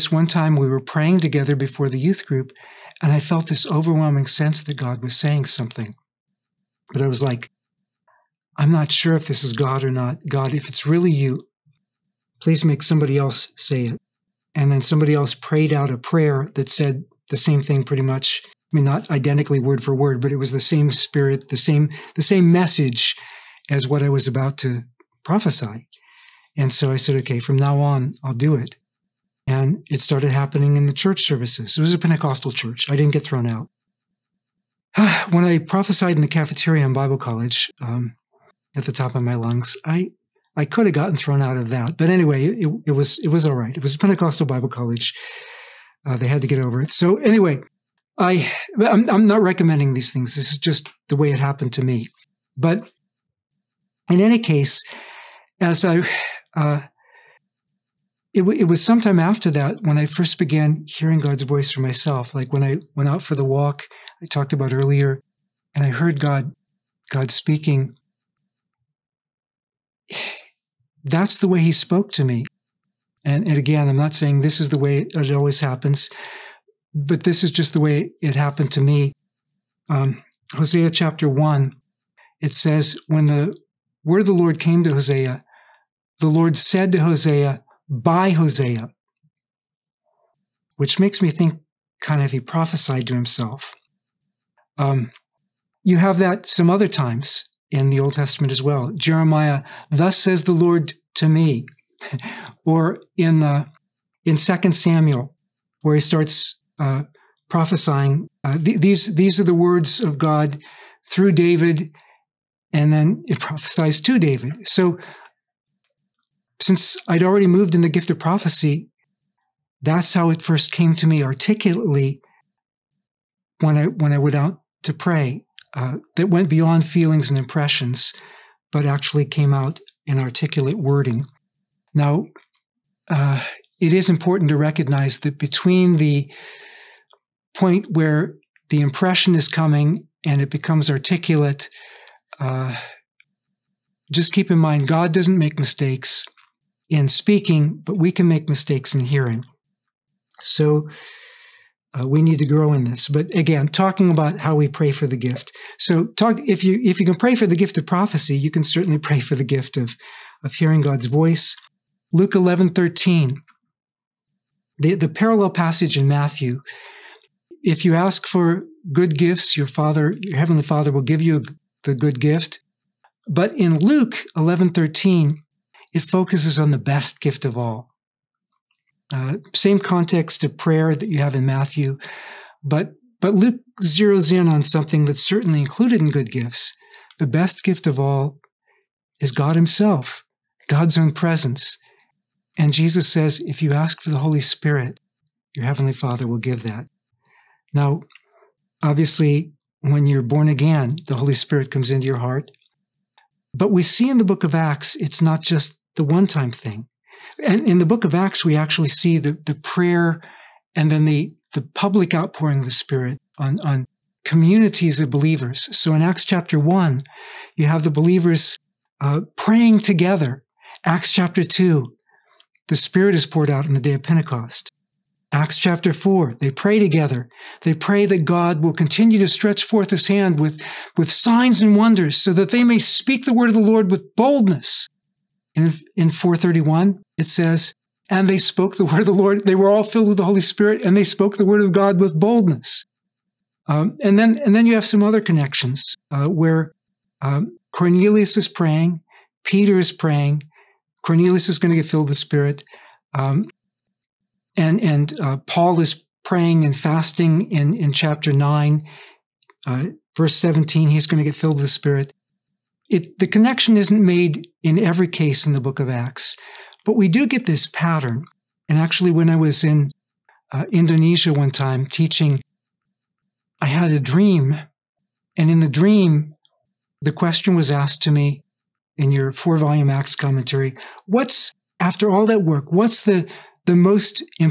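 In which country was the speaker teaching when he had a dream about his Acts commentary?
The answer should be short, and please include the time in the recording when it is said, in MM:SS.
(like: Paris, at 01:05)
Indonesia, at 04:30.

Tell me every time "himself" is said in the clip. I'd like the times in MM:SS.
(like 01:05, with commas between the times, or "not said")
01:33, 03:09.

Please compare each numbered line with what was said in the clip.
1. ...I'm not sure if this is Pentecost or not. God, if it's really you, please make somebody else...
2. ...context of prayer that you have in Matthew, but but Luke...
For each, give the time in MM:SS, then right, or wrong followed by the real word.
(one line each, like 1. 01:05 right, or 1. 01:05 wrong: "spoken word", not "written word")
1. 00:08 wrong: "God", not "Pentecost"
2. 02:59 right.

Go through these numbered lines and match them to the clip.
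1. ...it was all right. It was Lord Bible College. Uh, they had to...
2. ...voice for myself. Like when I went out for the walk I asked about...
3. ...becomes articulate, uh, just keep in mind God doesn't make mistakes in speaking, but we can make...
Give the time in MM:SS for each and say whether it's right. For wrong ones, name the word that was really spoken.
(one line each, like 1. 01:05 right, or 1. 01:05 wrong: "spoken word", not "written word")
1. 00:43 wrong: "Pentecostal", not "Lord"
2. 01:01 wrong: "talked", not "asked"
3. 02:20 right.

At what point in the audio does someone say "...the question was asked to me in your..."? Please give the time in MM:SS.
04:37.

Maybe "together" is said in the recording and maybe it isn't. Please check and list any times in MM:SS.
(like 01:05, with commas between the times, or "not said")
00:01, 03:39, 03:46.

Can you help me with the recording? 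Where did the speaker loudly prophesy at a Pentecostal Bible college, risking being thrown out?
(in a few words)
The cafeteria.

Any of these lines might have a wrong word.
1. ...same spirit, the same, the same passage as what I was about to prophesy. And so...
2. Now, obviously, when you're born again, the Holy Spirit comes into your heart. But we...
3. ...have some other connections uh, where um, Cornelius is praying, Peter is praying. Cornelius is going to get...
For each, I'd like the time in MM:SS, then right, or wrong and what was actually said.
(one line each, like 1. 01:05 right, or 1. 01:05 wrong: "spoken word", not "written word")
1. 00:20 wrong: "message", not "passage"
2. 03:17 right
3. 04:04 right.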